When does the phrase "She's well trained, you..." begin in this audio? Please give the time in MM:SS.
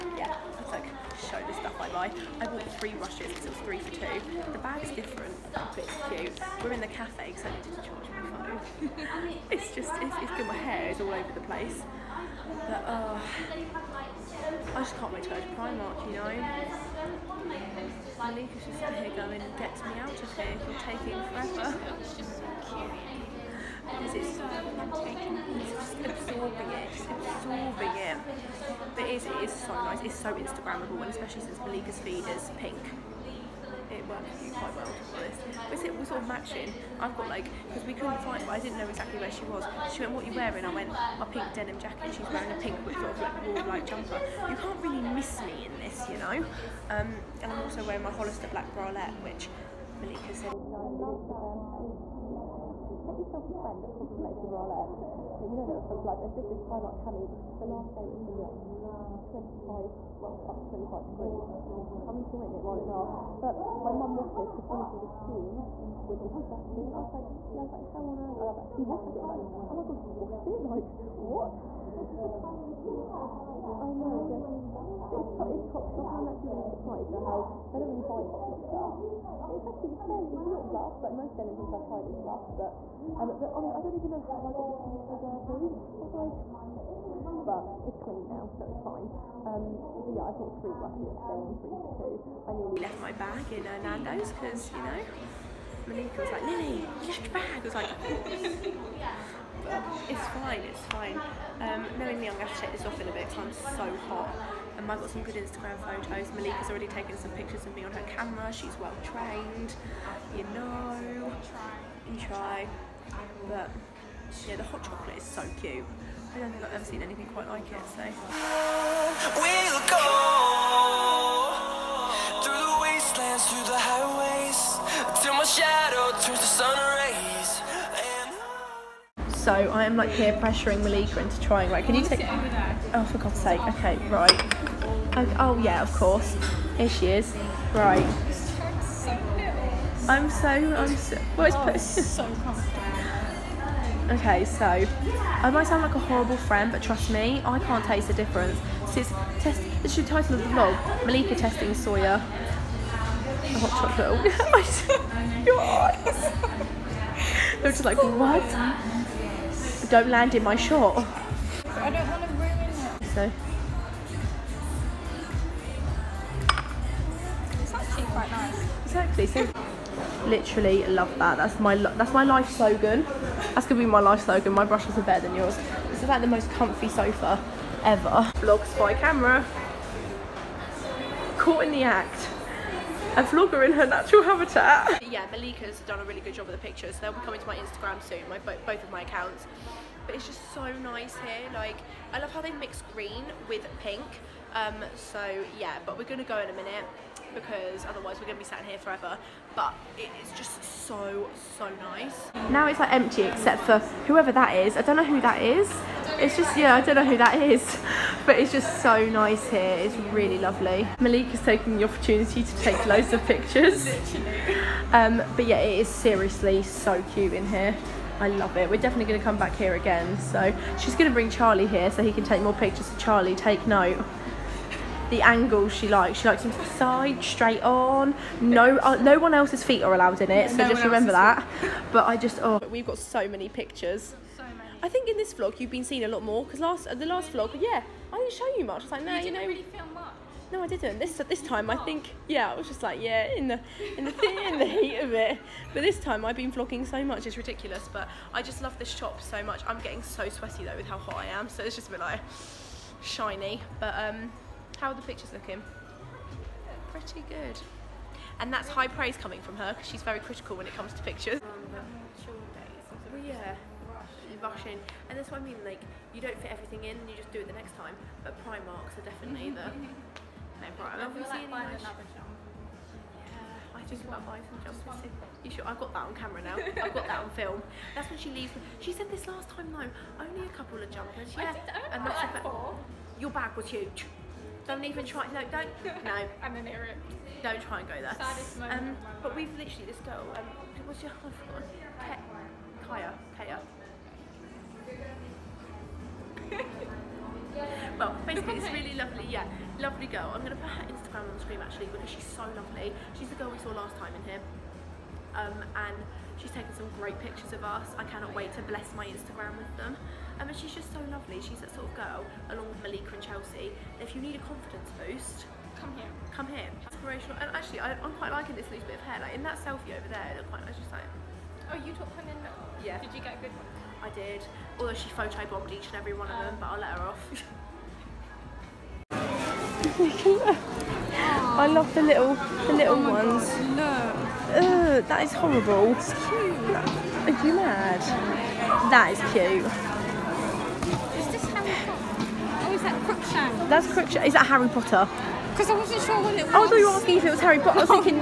01:48.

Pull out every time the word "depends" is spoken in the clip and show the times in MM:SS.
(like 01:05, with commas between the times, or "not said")
not said.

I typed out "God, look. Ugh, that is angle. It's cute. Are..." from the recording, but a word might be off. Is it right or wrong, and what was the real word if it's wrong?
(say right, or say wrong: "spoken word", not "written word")
wrong: "horrible", not "angle".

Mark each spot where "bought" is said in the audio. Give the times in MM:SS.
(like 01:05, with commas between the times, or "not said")
00:02, 01:30.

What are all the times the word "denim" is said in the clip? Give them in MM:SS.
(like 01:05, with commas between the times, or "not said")
00:41, 01:21.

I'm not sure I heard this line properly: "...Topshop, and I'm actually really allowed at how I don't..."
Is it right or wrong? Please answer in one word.
wrong.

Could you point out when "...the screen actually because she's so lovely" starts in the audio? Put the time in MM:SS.
05:01.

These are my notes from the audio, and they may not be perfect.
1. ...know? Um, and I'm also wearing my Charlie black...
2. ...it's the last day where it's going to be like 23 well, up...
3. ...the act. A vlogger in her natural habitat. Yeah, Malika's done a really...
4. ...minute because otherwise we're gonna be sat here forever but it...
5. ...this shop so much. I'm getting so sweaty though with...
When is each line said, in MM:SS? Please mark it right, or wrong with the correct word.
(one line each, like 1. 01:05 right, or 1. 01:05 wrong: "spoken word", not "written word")
1. 00:46 wrong: "Hollister", not "Charlie"
2. 00:57 wrong: "25", not "23"
3. 03:01 right
4. 03:16 right
5. 04:08 right.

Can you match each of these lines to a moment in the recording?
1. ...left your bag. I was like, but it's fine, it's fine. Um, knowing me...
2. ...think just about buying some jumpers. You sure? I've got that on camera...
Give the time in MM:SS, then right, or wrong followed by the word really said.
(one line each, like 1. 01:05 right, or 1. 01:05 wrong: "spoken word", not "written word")
1. 01:37 right
2. 04:33 right.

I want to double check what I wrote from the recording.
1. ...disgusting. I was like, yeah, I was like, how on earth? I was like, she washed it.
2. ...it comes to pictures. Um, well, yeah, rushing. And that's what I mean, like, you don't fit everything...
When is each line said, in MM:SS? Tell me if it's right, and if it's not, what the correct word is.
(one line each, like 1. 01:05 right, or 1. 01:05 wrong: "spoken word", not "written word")
1. 01:06 right
2. 04:20 right.